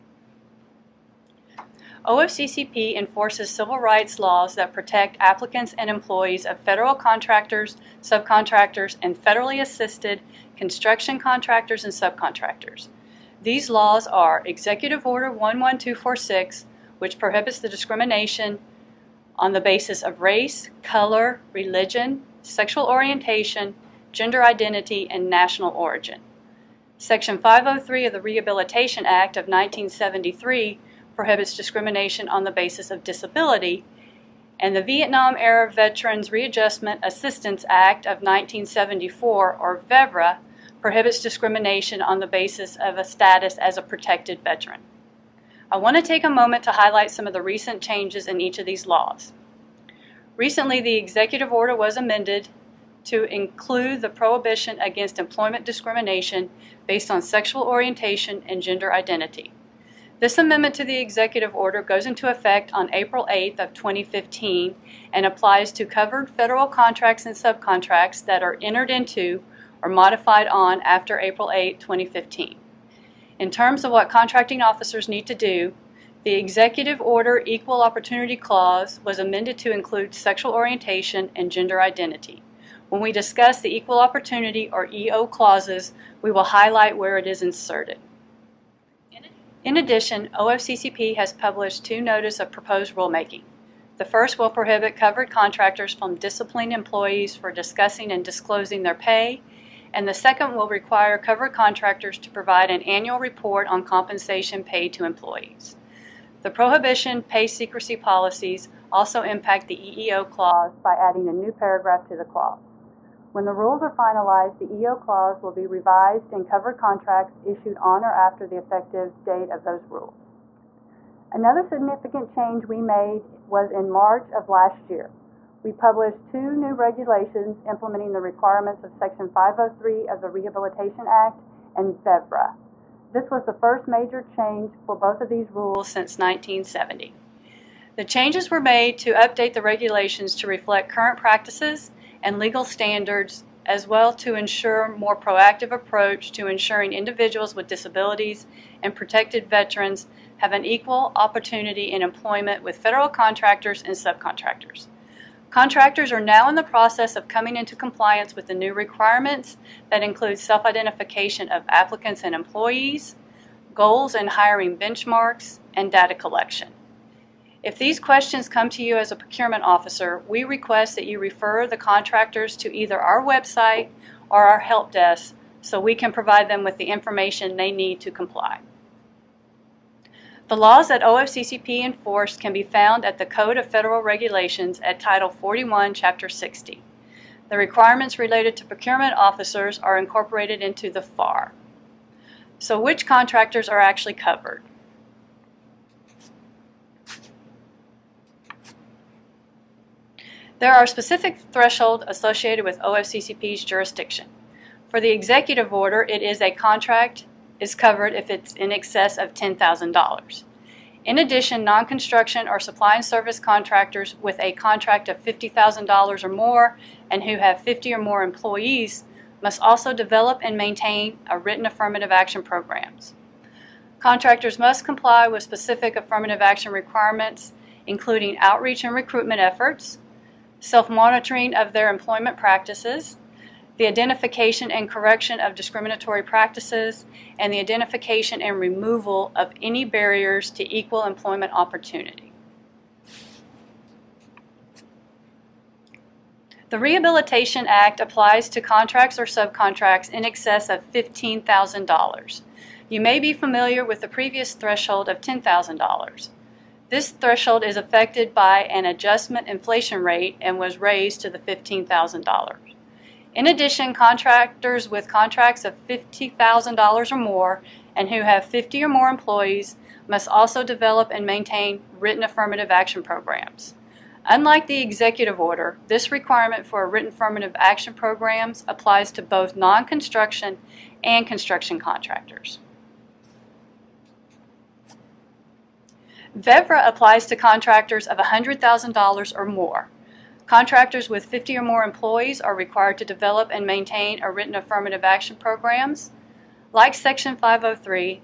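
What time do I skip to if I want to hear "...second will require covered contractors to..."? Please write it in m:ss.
1:40.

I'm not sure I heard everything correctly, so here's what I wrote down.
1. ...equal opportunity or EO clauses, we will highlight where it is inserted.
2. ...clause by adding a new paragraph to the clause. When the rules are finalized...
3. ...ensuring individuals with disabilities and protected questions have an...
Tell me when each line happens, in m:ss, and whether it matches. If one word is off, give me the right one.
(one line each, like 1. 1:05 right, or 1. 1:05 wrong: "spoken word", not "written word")
1. 1:23 right
2. 1:50 right
3. 2:26 wrong: "veterans", not "questions".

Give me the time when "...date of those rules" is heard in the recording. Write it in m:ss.
1:59.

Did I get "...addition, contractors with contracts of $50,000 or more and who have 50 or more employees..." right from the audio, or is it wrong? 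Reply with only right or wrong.
right.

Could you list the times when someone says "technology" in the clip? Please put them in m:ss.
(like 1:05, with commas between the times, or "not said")
not said.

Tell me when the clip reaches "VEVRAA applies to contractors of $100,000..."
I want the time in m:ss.
4:46.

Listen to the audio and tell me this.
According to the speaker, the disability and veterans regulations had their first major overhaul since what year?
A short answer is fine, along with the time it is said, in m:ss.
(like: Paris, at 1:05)
1970, at 2:16.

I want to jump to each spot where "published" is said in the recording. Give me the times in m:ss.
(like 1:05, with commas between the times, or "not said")
1:31, 2:05.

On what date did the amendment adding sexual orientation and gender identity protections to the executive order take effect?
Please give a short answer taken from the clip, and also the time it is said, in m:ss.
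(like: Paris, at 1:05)
April 8th of 2015, at 1:02.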